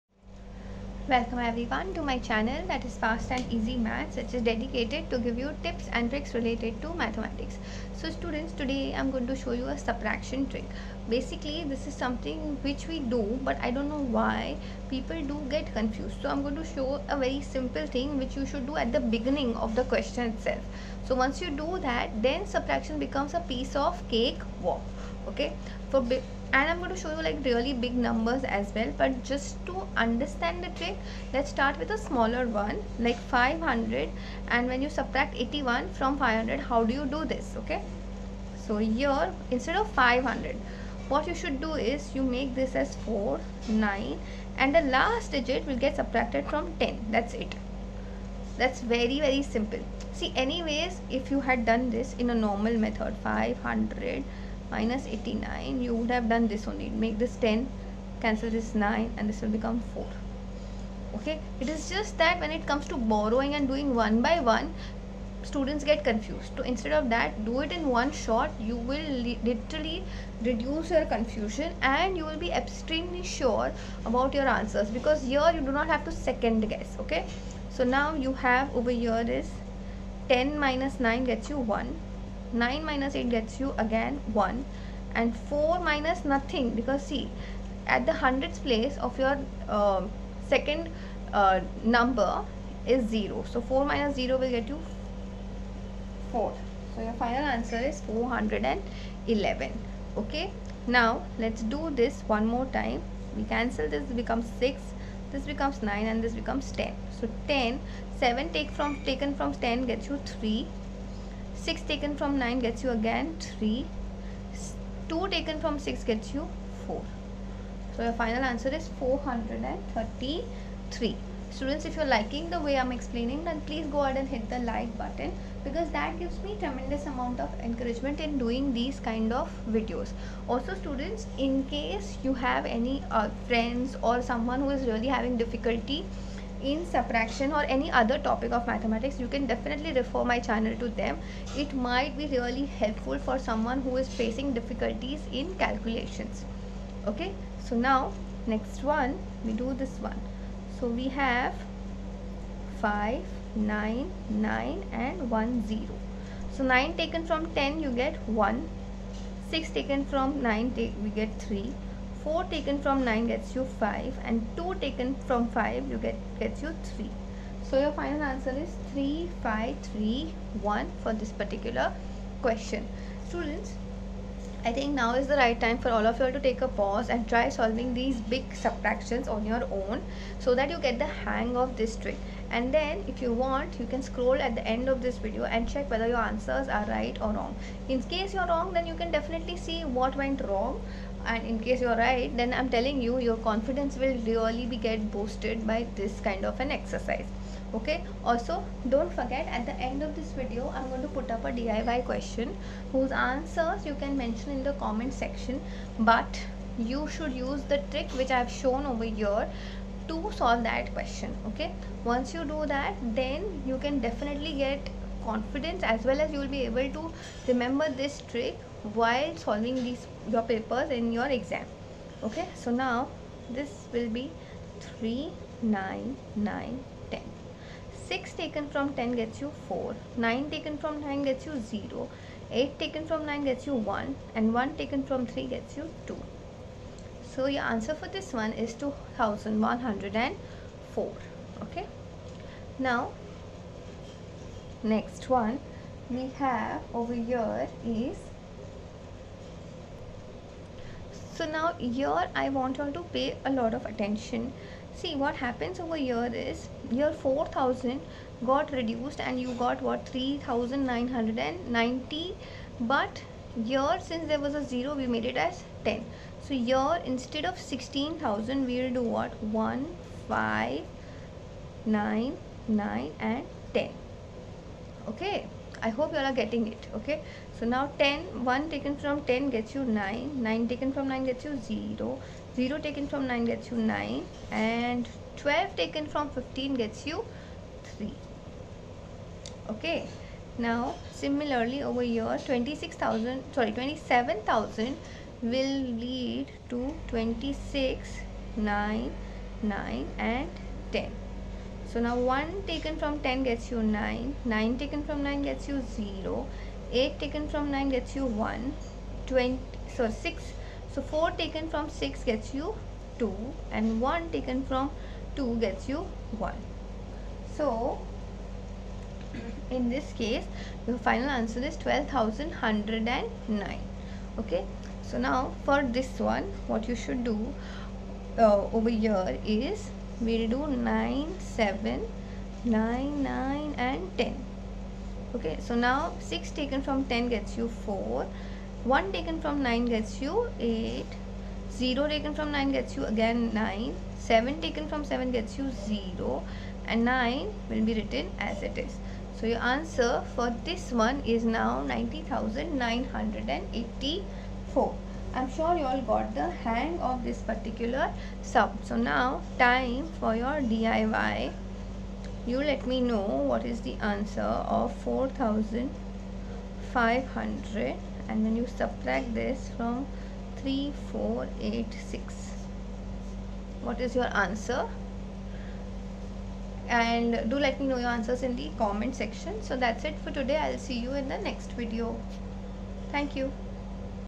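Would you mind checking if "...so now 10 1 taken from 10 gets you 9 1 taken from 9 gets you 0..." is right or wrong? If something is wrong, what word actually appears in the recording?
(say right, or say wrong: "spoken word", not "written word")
wrong: "9", not "1".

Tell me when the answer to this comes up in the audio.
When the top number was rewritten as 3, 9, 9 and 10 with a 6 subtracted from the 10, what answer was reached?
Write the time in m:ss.
3:57.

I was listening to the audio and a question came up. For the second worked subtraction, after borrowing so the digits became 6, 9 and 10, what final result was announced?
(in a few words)
433.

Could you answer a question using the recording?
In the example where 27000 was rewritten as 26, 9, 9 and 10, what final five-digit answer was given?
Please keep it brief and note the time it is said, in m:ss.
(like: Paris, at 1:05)
12,109, at 5:20.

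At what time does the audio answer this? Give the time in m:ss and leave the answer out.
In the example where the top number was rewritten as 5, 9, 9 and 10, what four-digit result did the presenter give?
2:47.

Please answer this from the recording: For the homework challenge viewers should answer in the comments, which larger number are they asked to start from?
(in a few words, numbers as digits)
4500.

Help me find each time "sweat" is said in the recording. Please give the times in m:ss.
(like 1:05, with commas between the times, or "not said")
not said.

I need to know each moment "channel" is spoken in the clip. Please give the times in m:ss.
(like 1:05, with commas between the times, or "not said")
0:02, 2:20.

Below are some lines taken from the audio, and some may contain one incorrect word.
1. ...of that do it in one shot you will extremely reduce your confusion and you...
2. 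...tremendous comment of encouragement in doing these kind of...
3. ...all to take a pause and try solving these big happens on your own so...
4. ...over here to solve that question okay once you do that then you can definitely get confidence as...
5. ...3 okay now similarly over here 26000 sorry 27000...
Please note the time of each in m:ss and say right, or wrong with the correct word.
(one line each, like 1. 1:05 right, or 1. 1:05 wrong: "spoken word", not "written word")
1. 1:06 wrong: "literally", not "extremely"
2. 2:06 wrong: "amount", not "comment"
3. 2:56 wrong: "subtractions", not "happens"
4. 3:28 right
5. 4:47 right.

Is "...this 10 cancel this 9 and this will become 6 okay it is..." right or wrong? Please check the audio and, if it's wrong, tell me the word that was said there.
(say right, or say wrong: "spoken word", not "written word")
wrong: "4", not "6".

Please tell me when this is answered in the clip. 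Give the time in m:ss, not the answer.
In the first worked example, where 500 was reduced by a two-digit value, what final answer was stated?
1:37.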